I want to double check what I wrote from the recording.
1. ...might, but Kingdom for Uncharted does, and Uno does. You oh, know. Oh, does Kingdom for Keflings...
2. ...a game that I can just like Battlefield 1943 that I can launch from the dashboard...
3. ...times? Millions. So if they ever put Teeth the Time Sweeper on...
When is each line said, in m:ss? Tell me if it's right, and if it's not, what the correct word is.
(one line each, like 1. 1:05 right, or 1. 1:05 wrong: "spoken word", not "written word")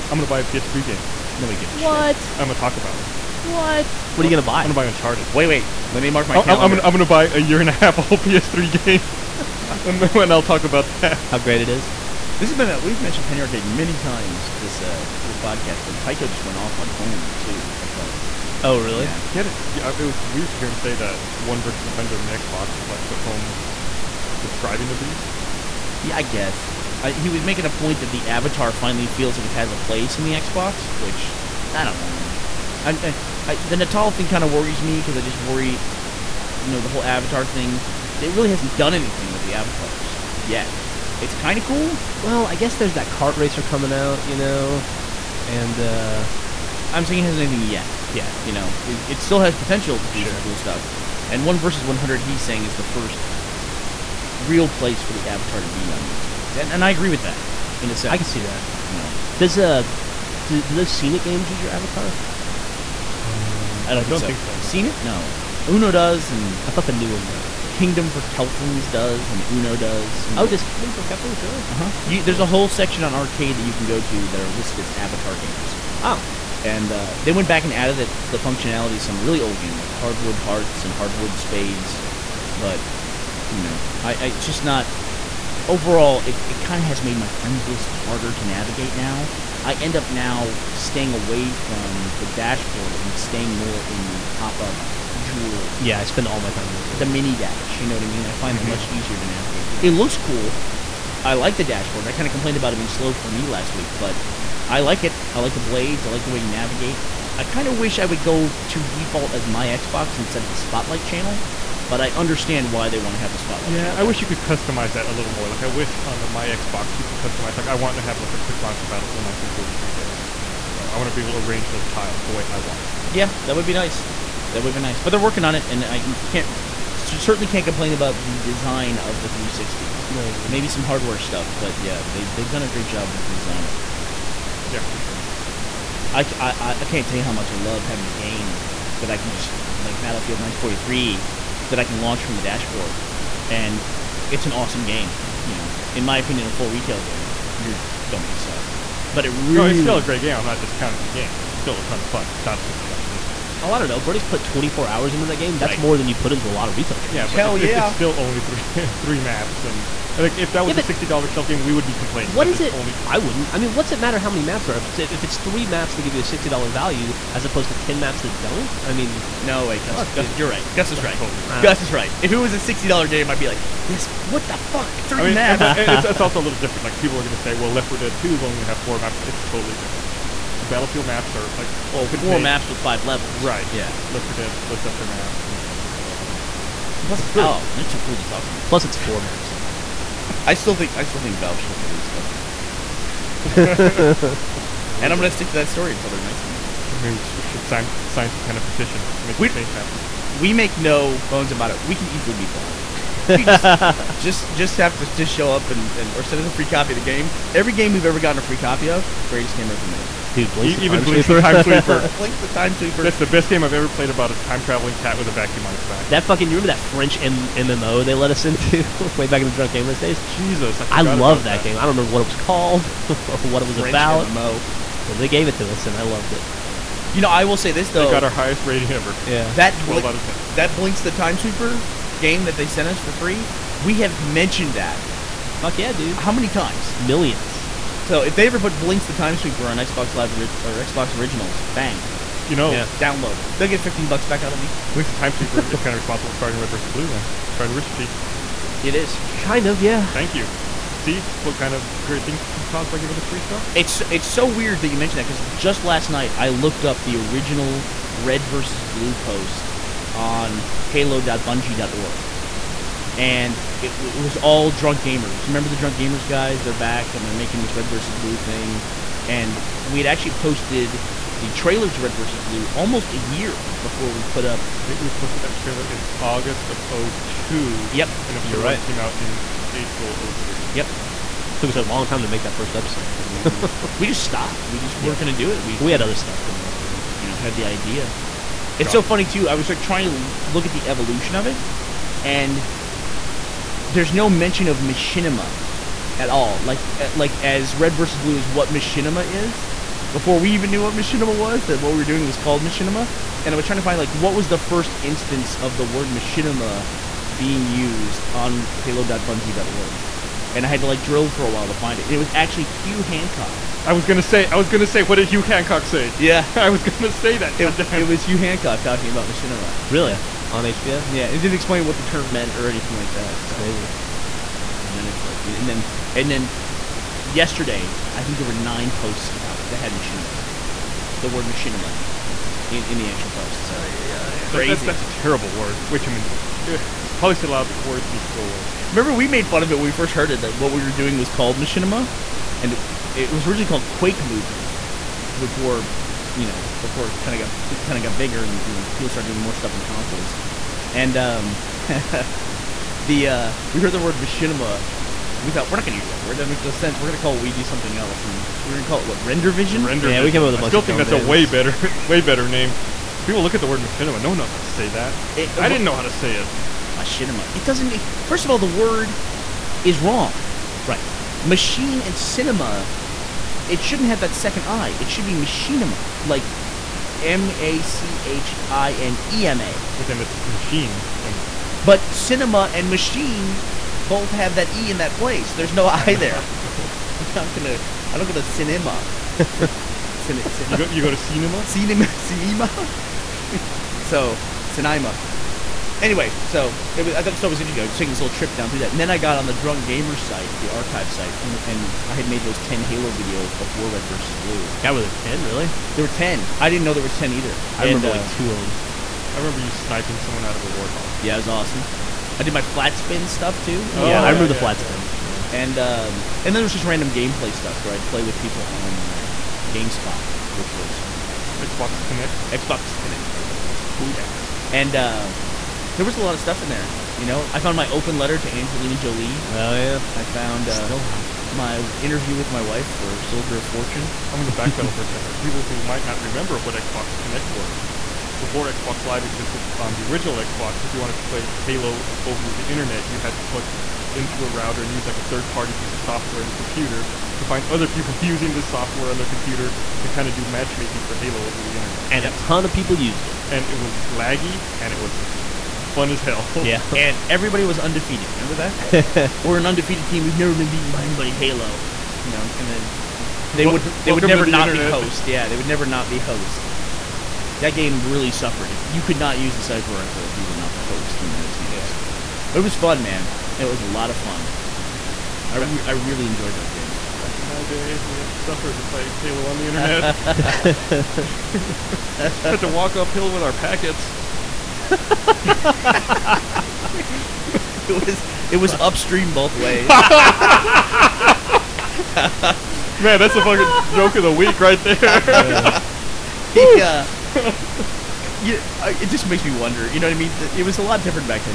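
1. 1:07 wrong: "Keflings", not "Uncharted"
2. 2:18 right
3. 3:56 wrong: "Blinx", not "Teeth".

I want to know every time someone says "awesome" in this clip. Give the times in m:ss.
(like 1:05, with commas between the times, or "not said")
2:24, 6:51.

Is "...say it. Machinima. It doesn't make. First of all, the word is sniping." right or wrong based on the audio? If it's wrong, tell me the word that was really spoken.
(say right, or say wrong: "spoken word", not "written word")
wrong: "wrong", not "sniping".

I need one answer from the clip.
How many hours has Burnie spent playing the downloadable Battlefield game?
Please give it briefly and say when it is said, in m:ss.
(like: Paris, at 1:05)
24, at 2:34.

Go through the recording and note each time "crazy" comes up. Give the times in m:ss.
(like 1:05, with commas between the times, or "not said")
5:23, 5:34.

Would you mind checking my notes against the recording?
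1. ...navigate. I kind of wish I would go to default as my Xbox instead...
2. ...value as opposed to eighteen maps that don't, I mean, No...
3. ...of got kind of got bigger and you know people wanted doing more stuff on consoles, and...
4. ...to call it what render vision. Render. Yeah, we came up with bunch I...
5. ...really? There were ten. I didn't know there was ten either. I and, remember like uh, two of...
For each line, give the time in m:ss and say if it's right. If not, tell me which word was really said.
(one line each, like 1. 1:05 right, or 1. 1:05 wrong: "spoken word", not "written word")
1. 1:46 right
2. 2:46 wrong: "ten", not "eighteen"
3. 5:47 wrong: "started", not "wanted"
4. 5:58 right
5. 6:45 right.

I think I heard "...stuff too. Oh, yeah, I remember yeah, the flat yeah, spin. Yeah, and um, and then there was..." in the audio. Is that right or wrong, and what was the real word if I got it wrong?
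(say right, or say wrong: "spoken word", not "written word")
right.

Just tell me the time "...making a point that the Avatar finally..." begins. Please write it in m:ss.
0:27.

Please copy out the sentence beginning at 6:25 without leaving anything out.
There's no I, I know, there.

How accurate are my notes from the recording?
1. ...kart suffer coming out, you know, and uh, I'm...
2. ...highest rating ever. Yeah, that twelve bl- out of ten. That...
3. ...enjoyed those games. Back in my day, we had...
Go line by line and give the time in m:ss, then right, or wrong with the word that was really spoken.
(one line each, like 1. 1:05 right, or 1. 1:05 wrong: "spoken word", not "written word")
1. 0:43 wrong: "racer", not "suffer"
2. 3:48 right
3. 7:56 right.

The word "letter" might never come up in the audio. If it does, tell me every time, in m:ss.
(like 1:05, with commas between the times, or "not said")
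7:08.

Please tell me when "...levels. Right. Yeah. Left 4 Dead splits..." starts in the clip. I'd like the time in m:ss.
3:03.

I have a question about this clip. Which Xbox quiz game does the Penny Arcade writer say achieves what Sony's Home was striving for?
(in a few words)
1 versus 100.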